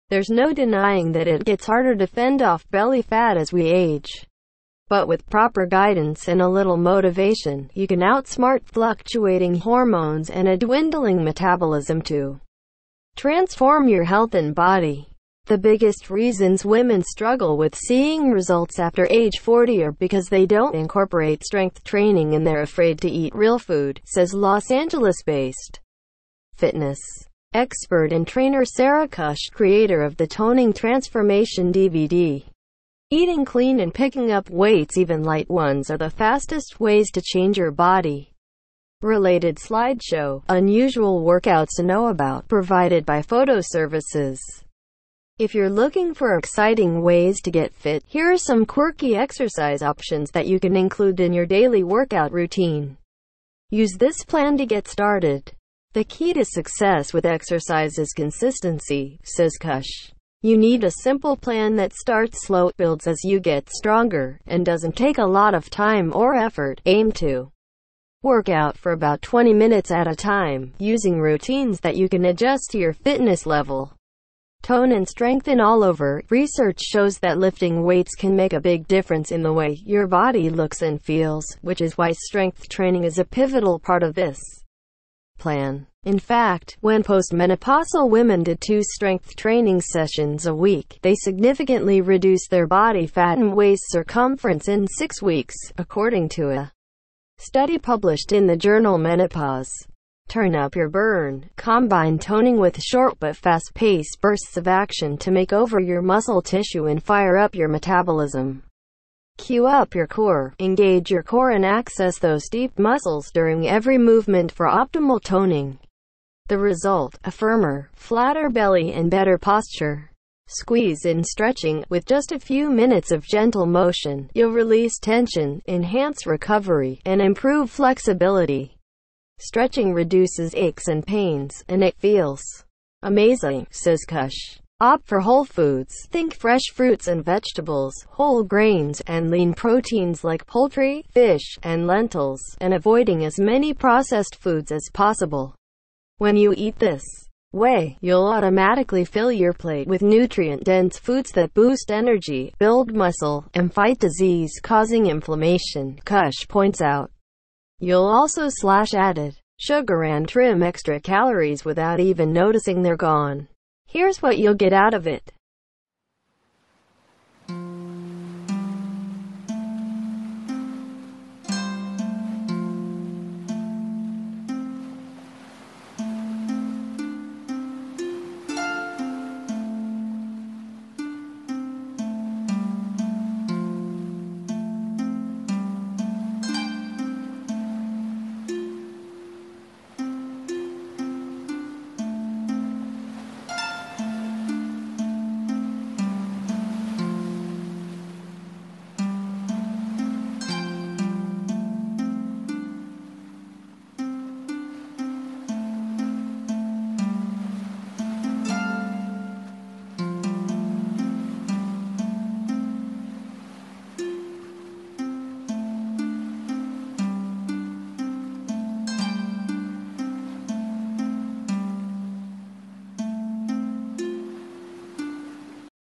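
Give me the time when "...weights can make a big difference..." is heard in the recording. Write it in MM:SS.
01:17.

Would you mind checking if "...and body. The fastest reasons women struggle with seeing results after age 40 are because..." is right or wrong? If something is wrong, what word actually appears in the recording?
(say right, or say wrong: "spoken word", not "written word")
wrong: "biggest", not "fastest".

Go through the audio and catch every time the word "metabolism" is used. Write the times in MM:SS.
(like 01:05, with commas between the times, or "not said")
00:11, 01:47.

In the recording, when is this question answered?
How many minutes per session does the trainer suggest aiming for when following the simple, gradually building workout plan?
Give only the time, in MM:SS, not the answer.
01:09.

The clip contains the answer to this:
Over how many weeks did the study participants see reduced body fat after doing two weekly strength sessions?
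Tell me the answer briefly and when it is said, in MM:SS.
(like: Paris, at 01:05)
6 weeks, at 01:34.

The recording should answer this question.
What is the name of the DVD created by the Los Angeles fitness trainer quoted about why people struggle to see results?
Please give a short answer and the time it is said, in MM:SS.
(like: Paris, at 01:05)
Toning Transformation, at 00:30.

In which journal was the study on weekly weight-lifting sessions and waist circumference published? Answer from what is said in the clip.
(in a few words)
Menopause.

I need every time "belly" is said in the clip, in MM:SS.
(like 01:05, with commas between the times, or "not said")
00:02, 01:58.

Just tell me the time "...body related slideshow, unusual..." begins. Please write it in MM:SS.
00:37.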